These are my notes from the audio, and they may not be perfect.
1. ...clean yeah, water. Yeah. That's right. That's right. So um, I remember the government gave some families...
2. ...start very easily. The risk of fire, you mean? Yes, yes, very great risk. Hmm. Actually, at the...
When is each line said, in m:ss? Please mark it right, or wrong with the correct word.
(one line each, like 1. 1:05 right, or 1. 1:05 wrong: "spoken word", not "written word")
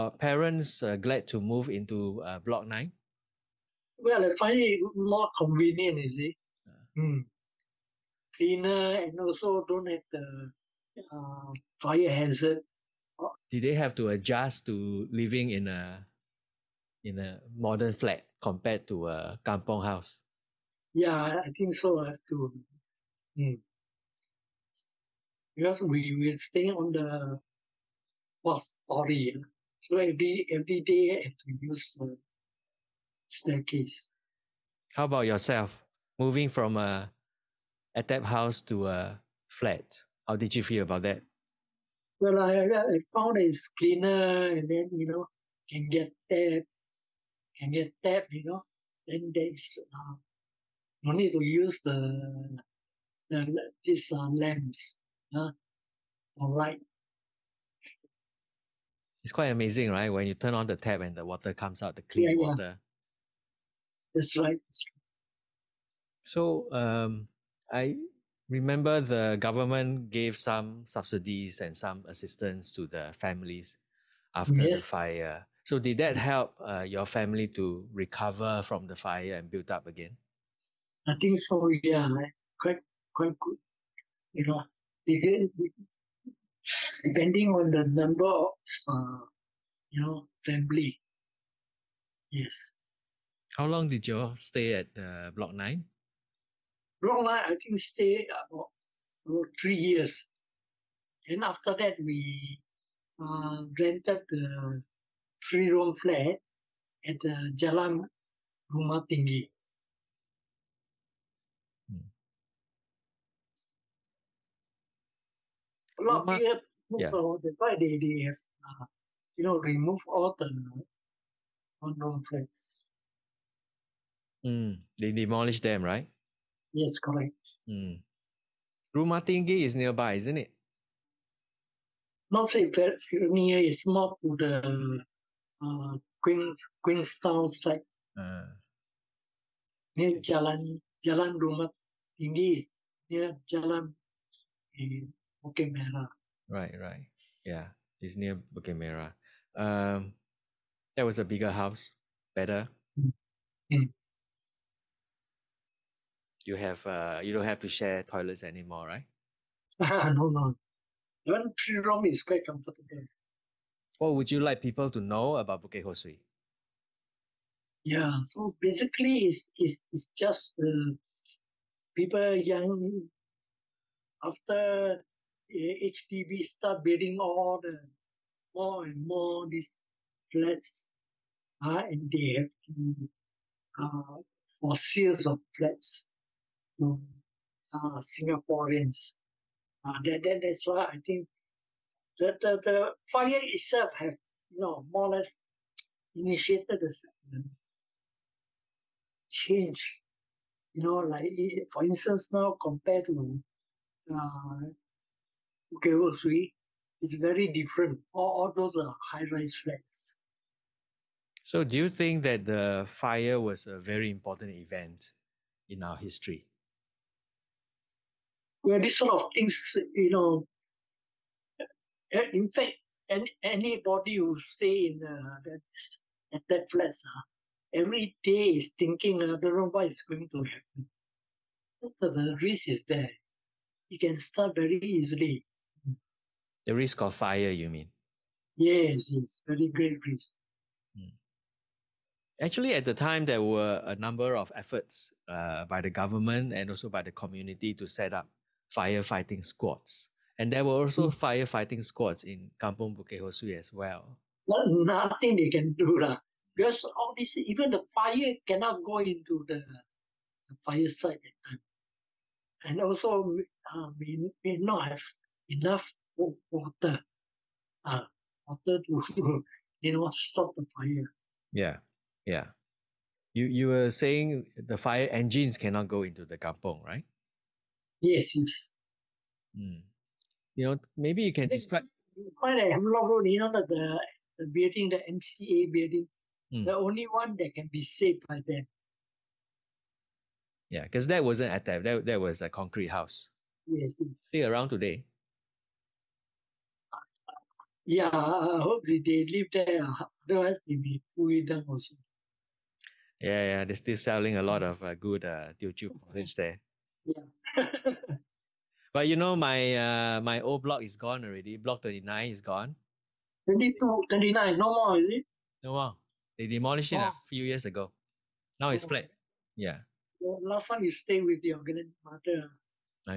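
1. 1:02 wrong: "subsidies", not "families"
2. 3:54 right.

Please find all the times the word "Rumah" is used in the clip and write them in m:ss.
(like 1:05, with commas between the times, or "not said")
1:48, 1:56, 2:21.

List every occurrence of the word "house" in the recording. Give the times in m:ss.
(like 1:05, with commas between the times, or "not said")
0:19, 0:38, 2:31, 4:52.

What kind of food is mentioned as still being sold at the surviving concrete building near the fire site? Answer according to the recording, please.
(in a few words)
Teochew porridge.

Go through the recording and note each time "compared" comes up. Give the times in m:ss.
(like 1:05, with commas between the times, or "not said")
0:18, 3:22.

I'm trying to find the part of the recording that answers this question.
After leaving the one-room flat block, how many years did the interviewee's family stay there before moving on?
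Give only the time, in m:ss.
1:39.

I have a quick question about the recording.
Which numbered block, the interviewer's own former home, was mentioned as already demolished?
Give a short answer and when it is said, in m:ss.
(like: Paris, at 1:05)
Block 29, at 5:11.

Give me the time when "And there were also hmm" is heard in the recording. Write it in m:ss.
4:10.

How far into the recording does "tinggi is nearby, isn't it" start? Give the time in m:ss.
2:09.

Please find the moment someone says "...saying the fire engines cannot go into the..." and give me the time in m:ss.
4:33.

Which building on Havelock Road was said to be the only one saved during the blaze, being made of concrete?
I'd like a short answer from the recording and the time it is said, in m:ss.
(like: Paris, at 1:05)
MCA building, at 4:45.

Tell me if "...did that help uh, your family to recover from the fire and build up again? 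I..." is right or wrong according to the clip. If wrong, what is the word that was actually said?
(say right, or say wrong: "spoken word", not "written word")
right.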